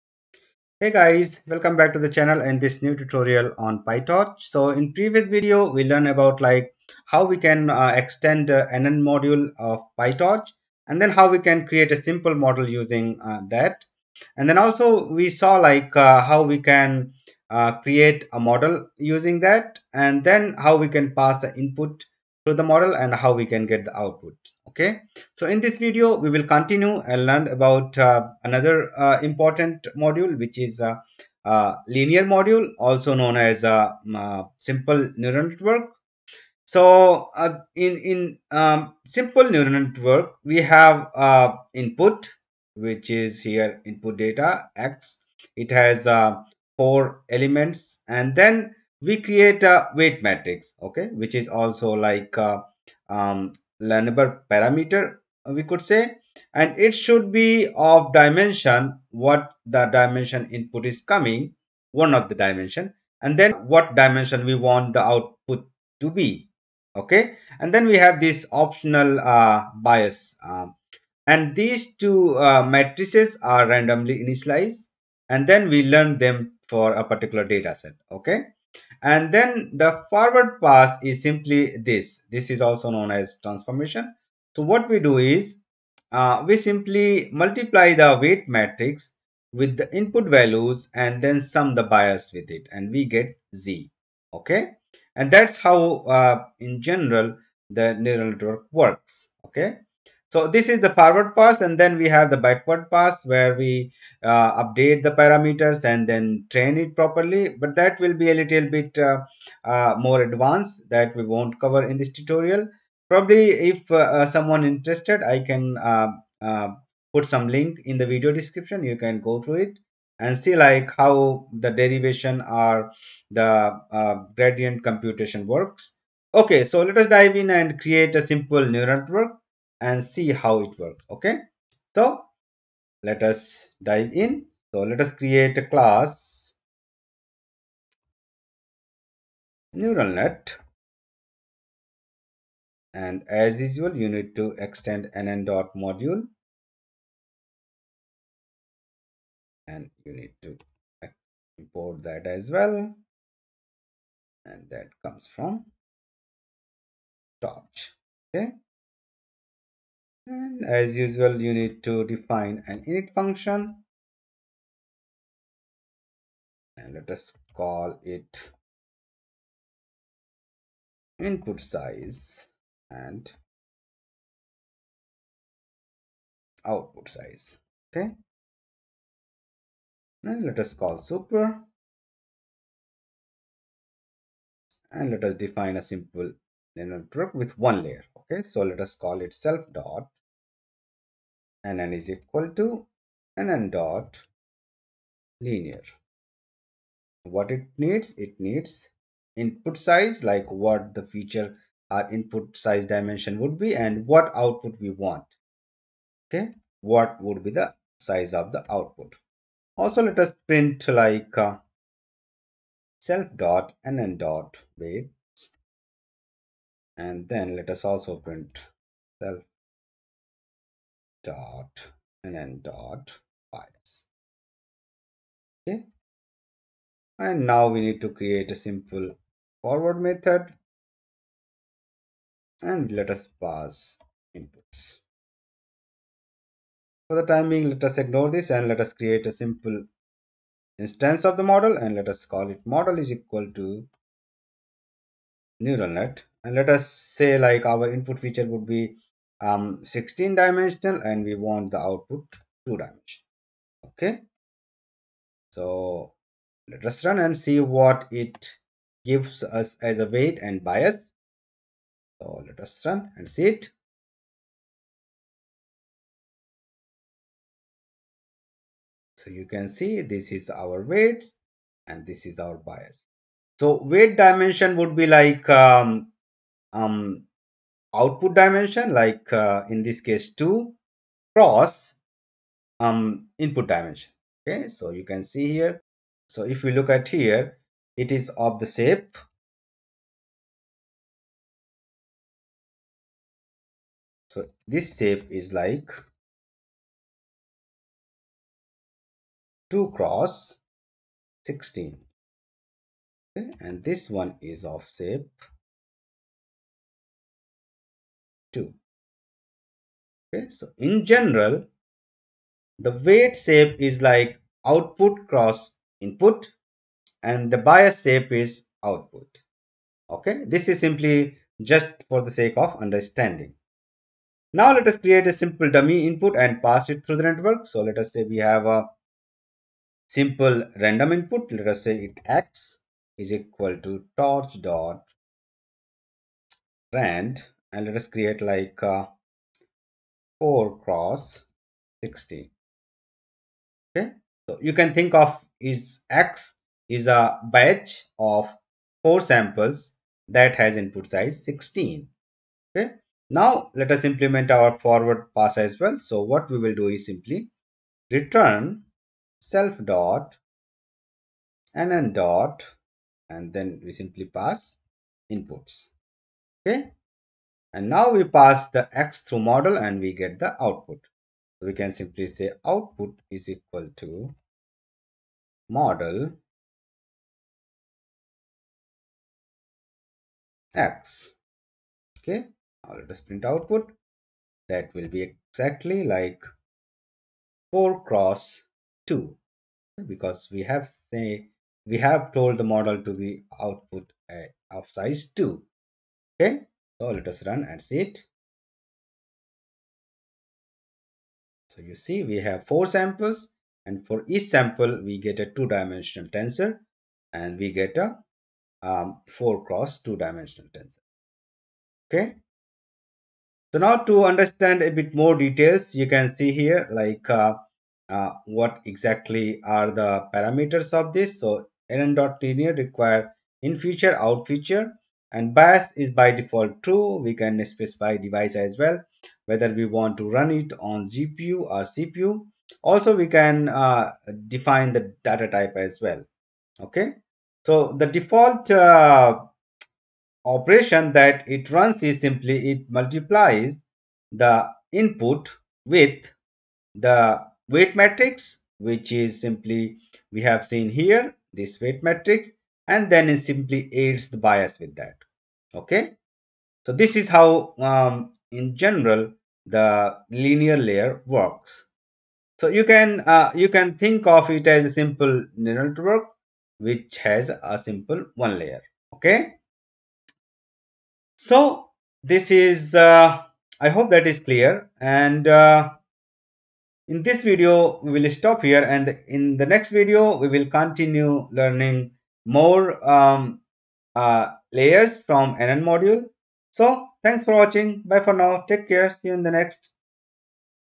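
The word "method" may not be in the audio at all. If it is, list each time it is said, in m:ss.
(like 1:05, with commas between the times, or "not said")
3:50.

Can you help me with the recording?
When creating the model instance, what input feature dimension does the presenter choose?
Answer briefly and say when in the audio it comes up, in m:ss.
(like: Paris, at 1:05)
16, at 4:09.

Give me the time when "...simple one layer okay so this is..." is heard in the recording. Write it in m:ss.
7:47.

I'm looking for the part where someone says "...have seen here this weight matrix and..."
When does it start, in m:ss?
7:30.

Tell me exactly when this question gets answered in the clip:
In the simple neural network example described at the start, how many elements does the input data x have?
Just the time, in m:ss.
0:46.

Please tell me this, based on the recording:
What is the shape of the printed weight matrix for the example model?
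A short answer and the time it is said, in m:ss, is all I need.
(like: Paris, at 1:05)
2 x 16, at 4:59.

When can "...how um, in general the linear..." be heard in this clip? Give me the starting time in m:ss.
7:37.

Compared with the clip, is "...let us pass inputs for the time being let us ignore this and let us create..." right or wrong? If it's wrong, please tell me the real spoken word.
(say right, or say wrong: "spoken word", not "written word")
right.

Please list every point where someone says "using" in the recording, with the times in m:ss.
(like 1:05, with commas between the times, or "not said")
0:12, 0:18.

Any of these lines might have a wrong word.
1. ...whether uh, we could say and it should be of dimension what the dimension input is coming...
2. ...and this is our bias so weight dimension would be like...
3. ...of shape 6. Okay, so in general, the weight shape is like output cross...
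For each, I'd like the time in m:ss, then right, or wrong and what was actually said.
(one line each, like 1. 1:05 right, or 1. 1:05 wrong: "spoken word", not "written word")
1. 0:54 wrong: "parameter", not "whether"
2. 4:31 right
3. 5:04 wrong: "2", not "6".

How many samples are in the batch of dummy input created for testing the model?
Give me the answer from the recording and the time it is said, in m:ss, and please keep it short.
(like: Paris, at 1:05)
4, at 5:47.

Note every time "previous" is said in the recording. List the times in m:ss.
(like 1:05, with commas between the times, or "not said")
0:04.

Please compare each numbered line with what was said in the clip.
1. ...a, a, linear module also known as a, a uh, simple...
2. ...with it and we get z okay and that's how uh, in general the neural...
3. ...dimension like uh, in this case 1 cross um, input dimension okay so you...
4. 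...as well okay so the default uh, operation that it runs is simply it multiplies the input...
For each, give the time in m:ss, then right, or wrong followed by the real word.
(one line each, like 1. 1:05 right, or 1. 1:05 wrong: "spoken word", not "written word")
1. 0:30 right
2. 1:32 right
3. 4:38 wrong: "2", not "1"
4. 7:15 right.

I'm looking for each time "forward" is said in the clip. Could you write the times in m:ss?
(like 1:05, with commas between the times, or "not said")
1:20, 1:40, 3:49, 5:54.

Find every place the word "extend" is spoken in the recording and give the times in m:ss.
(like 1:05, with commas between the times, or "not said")
0:07, 2:24.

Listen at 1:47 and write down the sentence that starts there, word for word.
But that will be a little bit uh, uh, more advanced that we won't cover in this tutorial.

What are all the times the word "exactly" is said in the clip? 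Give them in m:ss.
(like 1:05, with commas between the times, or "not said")
6:25, 6:58.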